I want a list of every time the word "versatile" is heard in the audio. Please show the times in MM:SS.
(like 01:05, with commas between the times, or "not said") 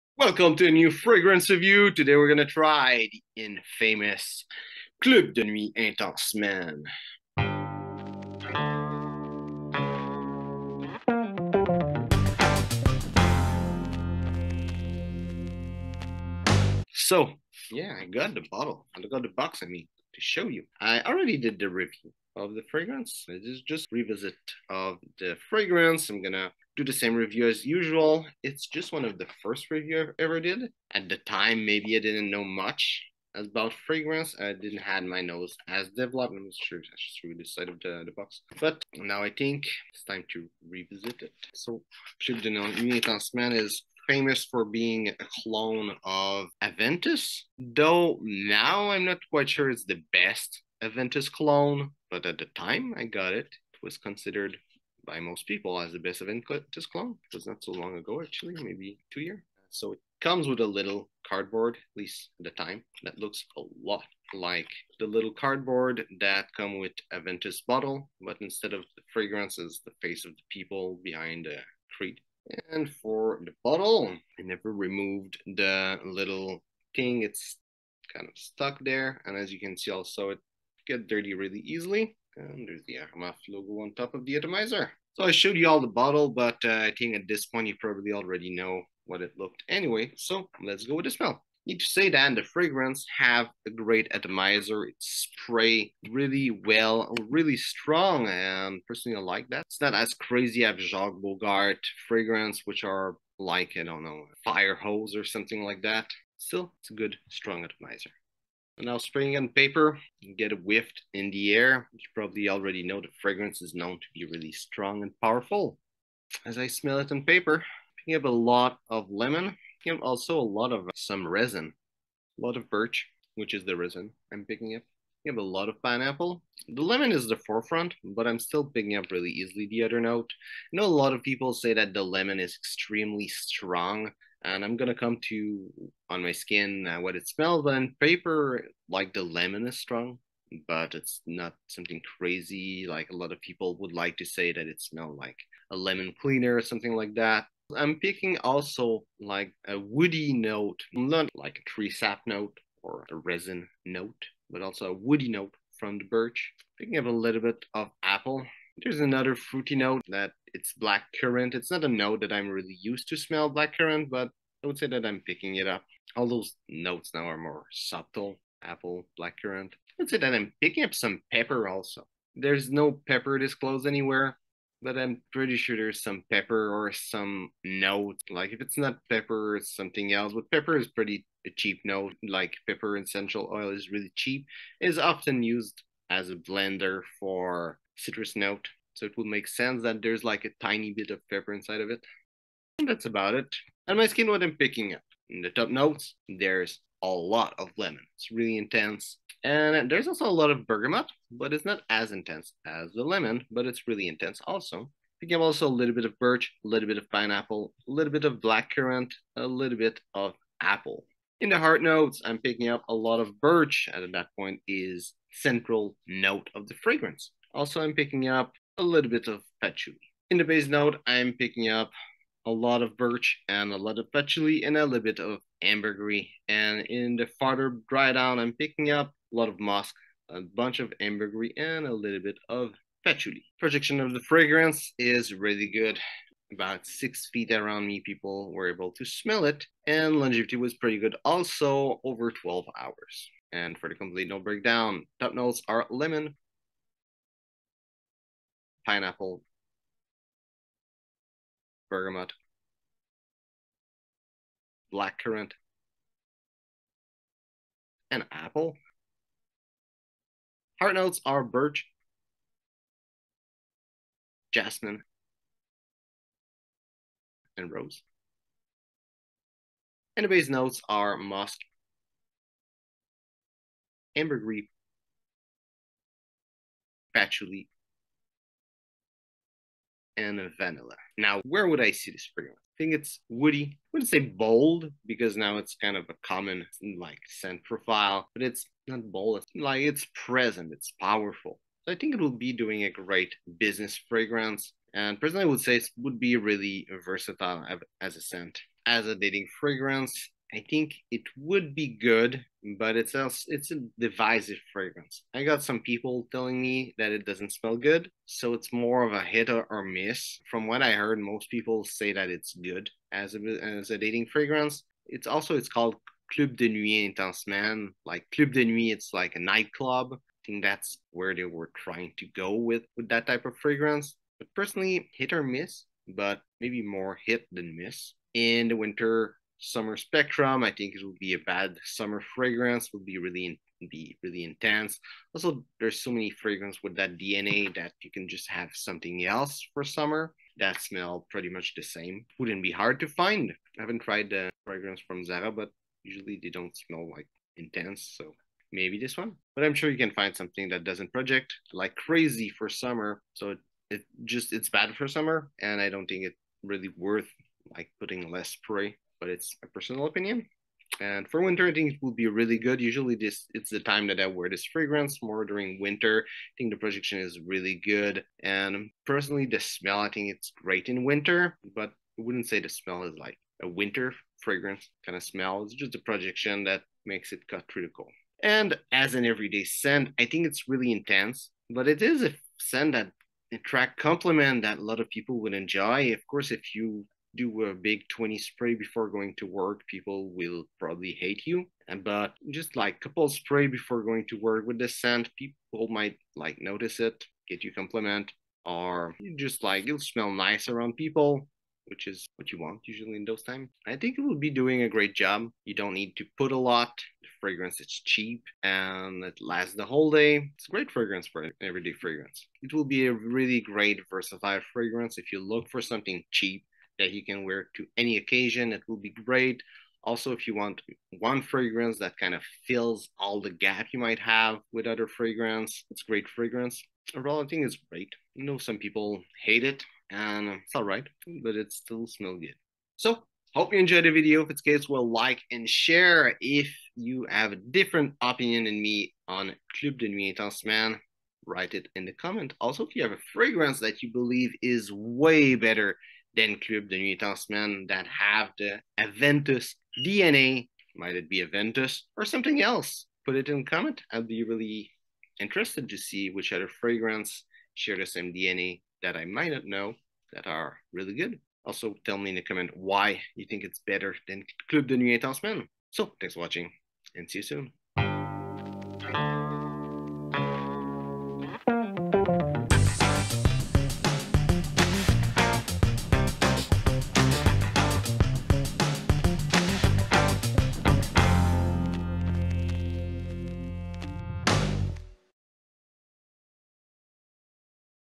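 04:57, 06:54.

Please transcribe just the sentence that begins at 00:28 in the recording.
It's just one of the first review I ever did.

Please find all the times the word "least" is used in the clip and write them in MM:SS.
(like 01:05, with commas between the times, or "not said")
01:01.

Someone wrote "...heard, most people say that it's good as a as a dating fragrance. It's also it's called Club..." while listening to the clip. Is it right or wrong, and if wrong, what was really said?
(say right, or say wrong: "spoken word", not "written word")
right.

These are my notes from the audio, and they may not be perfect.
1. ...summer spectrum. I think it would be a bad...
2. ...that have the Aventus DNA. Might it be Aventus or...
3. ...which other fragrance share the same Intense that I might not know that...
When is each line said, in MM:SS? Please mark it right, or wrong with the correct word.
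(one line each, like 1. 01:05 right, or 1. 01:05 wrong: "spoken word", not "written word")
1. 05:29 right
2. 07:27 right
3. 07:36 wrong: "DNA", not "Intense".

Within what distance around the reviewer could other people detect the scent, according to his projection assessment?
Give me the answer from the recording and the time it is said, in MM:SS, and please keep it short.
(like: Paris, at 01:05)
6 feet, at 03:56.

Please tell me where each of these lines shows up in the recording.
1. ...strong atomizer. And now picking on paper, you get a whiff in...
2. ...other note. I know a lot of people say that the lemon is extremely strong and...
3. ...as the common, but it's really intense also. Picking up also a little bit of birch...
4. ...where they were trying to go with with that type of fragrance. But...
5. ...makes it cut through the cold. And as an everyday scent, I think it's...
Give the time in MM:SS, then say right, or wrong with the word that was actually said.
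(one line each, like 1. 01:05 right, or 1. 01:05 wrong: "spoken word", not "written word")
1. 01:47 wrong: "spraying", not "picking"
2. 02:09 right
3. 03:22 wrong: "lemon", not "common"
4. 05:21 right
5. 06:17 right.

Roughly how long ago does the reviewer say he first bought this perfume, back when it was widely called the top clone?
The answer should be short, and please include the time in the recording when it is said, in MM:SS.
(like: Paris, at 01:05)
2 years, at 00:59.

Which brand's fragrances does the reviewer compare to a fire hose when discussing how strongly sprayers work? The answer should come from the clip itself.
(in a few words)
Jacques Bogart.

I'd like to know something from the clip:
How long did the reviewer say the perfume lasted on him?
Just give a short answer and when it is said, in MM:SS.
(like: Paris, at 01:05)
Over 12 hours, at 04:02.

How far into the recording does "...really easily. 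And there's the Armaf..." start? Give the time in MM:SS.
01:21.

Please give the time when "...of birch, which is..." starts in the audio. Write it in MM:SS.
02:02.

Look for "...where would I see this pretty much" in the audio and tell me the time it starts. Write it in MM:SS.
04:41.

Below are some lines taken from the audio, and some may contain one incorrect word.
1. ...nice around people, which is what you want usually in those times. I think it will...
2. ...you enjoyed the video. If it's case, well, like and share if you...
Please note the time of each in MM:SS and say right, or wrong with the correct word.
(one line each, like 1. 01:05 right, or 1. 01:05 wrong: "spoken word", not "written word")
1. 06:40 right
2. 07:13 right.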